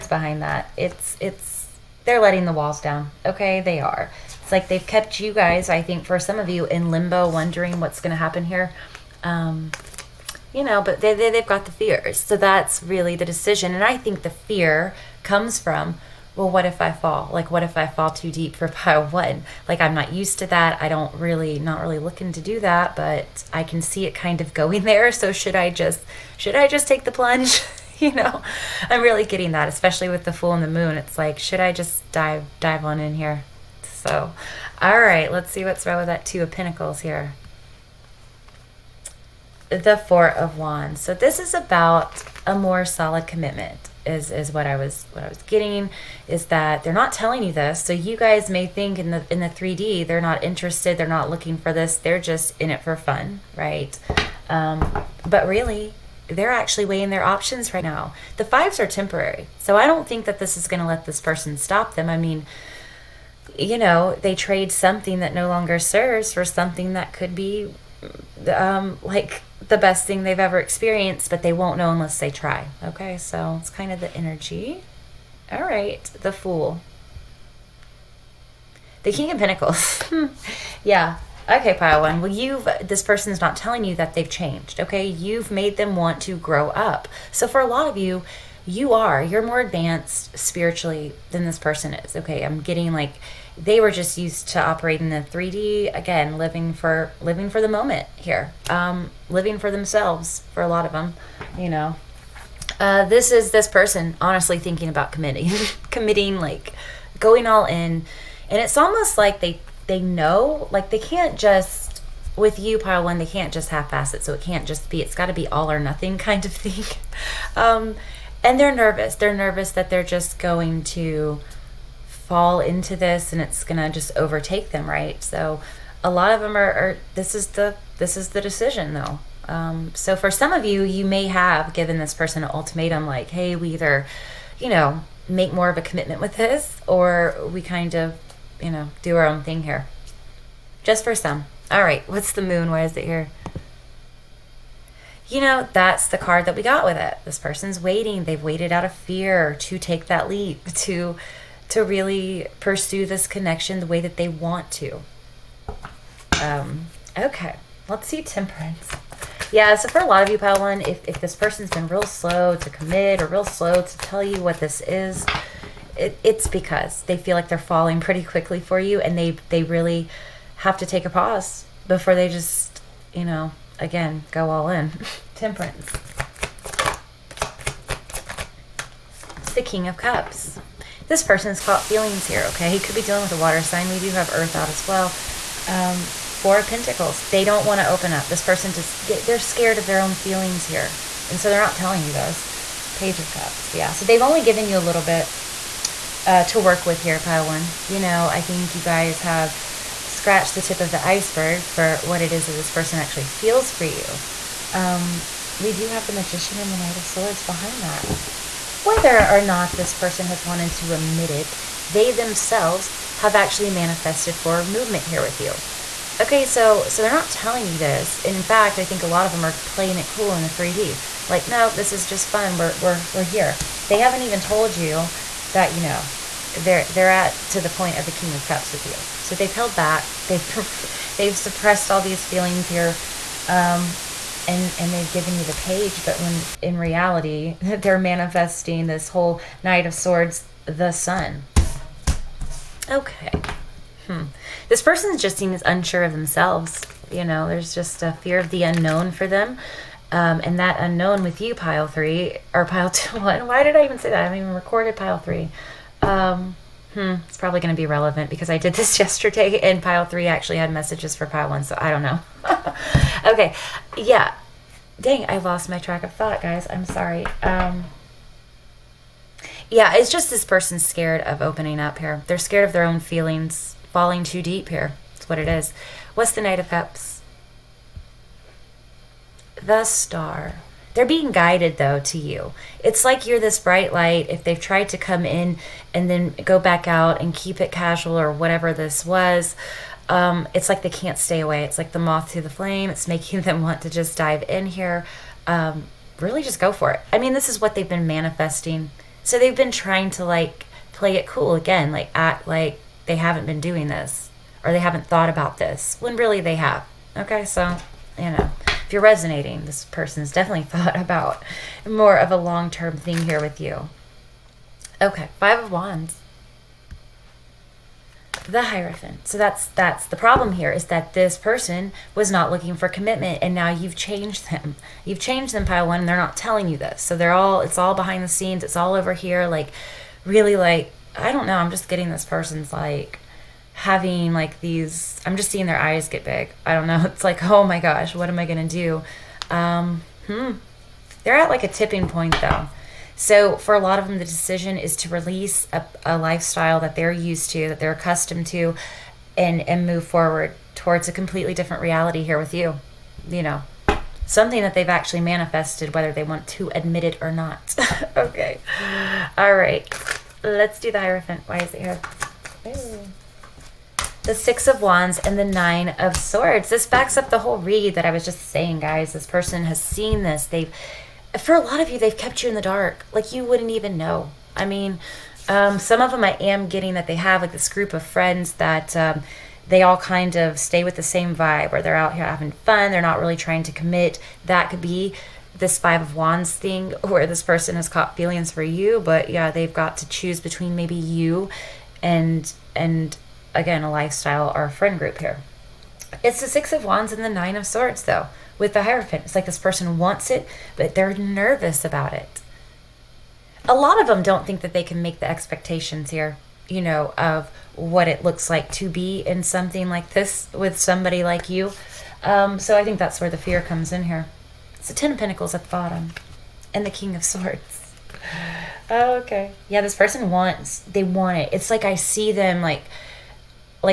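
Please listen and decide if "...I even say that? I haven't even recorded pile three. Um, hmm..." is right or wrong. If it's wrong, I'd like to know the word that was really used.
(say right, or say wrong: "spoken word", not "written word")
right.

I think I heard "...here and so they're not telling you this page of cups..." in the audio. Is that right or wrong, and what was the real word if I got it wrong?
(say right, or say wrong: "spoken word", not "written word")
right.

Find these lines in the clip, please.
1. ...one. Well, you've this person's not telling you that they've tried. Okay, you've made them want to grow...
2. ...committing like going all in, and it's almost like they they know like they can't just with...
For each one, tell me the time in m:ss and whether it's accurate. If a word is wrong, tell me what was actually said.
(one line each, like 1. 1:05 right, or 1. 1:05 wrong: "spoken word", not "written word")
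1. 1:22 wrong: "changed", not "tried"
2. 1:45 right.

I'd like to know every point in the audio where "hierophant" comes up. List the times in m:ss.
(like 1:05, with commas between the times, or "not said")
5:18, 6:00, 6:38.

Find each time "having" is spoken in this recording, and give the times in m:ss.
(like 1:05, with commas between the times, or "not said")
5:33, 6:22.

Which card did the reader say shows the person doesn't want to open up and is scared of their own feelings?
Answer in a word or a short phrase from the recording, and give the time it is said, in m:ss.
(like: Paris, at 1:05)
Four of Pentacles, at 3:06.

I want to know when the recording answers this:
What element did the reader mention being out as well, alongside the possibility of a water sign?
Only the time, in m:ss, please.
3:04.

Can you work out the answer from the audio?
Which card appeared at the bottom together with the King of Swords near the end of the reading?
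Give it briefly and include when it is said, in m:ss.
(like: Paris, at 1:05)
Ten of Pentacles, at 6:54.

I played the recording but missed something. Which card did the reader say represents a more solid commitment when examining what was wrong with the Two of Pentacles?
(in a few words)
Four of Wands.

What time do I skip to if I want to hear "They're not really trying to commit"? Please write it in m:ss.
6:22.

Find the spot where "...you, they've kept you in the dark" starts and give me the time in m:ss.
6:11.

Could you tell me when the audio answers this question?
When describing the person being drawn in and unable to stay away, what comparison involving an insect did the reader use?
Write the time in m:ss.
4:51.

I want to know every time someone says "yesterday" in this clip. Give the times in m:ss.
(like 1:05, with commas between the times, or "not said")
4:18.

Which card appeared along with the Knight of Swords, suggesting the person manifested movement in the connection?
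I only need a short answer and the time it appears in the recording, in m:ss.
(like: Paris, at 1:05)
the Magician, at 3:26.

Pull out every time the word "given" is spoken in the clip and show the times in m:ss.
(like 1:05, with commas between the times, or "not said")
2:11, 3:14, 3:55.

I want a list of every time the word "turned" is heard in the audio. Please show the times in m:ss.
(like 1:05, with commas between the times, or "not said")
not said.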